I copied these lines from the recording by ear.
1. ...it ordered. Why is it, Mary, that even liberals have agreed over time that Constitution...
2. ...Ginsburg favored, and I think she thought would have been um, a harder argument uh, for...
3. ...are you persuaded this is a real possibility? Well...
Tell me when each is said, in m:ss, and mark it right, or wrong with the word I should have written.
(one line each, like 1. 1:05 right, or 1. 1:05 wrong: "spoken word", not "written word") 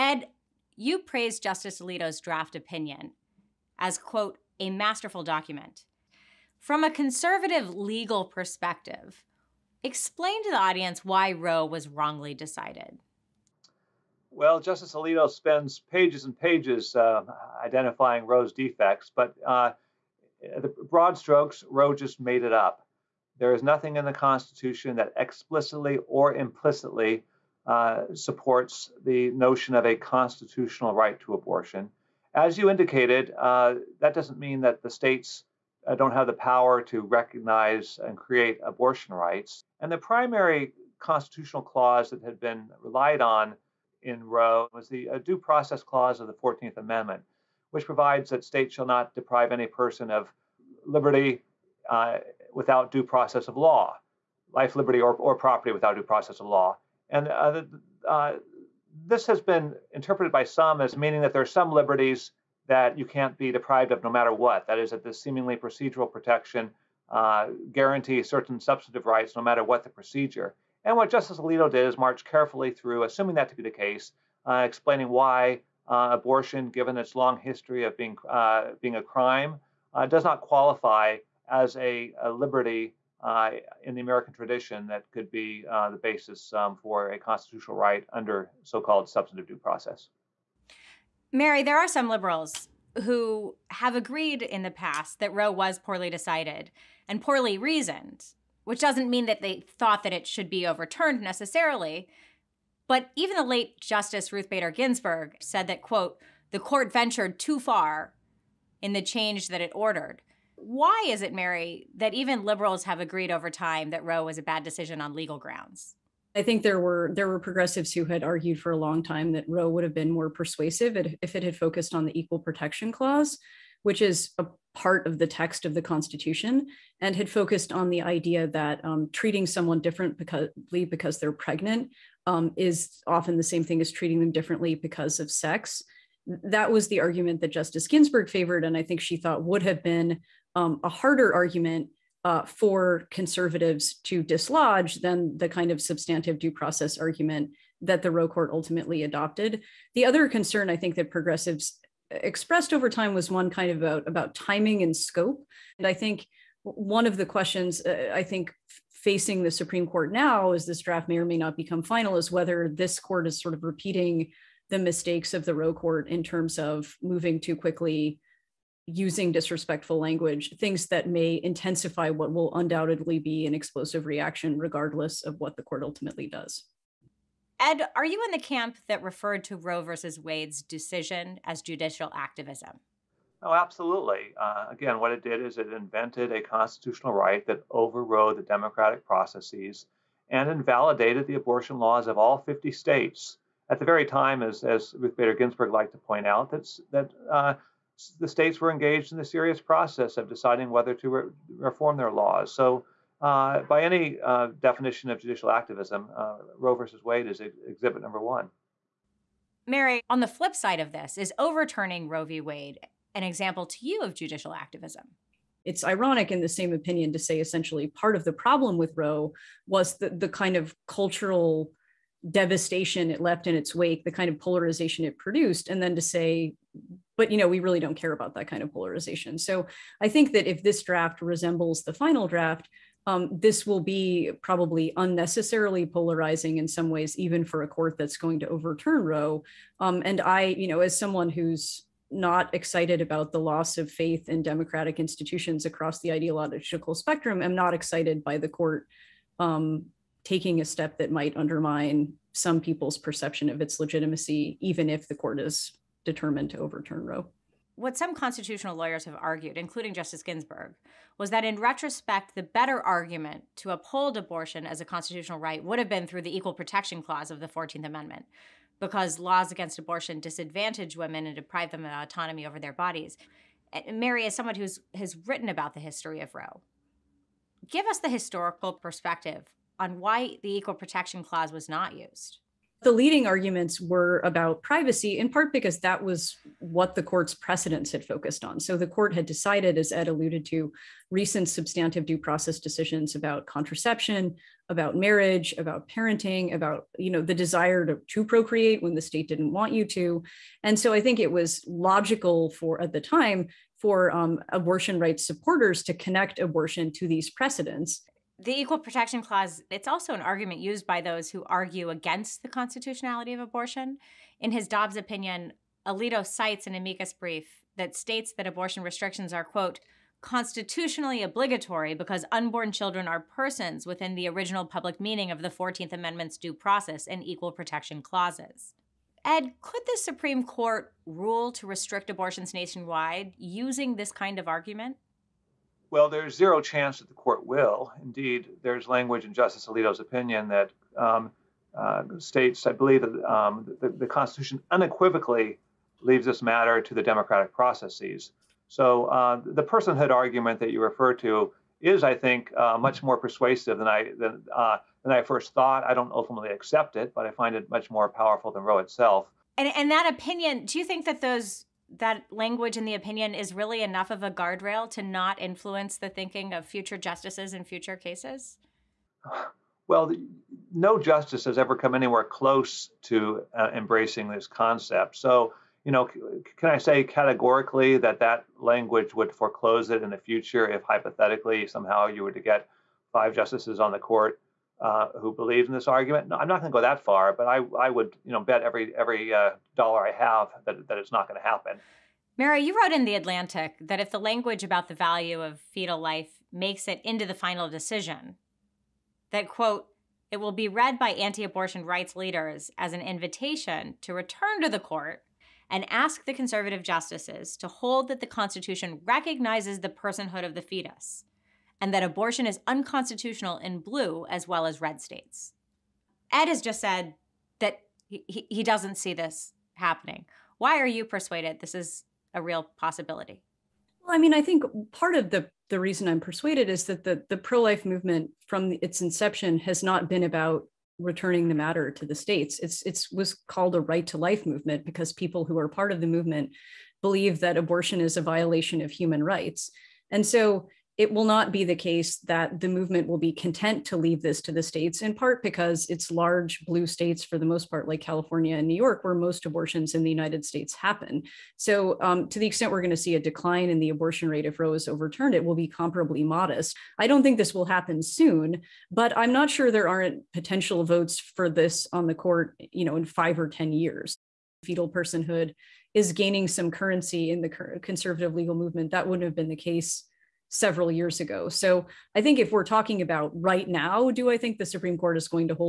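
1. 1:49 wrong: "Roe", not "Constitution"
2. 2:17 right
3. 7:00 right.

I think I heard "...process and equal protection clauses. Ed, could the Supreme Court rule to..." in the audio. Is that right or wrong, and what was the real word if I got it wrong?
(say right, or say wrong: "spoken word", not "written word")
right.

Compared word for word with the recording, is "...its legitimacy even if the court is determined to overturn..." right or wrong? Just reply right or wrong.
right.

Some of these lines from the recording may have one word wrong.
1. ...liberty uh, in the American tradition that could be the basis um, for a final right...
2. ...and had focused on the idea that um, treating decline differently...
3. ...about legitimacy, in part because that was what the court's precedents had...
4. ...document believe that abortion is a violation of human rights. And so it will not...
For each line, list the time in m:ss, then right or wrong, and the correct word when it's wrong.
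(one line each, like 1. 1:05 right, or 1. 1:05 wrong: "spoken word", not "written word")
1. 1:22 wrong: "constitutional", not "final"
2. 2:06 wrong: "someone", not "decline"
3. 4:44 wrong: "privacy", not "legitimacy"
4. 7:16 wrong: "movement", not "document".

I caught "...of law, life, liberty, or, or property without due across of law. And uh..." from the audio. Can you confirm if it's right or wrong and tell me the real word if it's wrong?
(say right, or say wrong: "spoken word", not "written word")
wrong: "process", not "across".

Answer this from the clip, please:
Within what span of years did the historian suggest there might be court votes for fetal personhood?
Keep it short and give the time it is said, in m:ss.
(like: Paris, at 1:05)
5 or 10 years, at 7:43.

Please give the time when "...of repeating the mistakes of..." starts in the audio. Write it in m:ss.
2:43.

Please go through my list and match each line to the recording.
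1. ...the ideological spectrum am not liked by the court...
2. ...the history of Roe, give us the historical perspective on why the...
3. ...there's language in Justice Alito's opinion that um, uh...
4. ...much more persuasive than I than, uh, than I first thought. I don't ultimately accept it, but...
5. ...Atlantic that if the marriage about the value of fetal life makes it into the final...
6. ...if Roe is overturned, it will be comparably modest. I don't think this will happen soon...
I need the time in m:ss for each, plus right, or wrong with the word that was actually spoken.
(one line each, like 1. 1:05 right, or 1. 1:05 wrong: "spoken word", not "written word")
1. 4:05 wrong: "excited", not "liked"
2. 4:35 right
3. 5:38 right
4. 5:52 right
5. 6:33 wrong: "language", not "marriage"
6. 7:34 right.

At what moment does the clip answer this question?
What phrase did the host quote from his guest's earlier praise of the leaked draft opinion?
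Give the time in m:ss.
0:04.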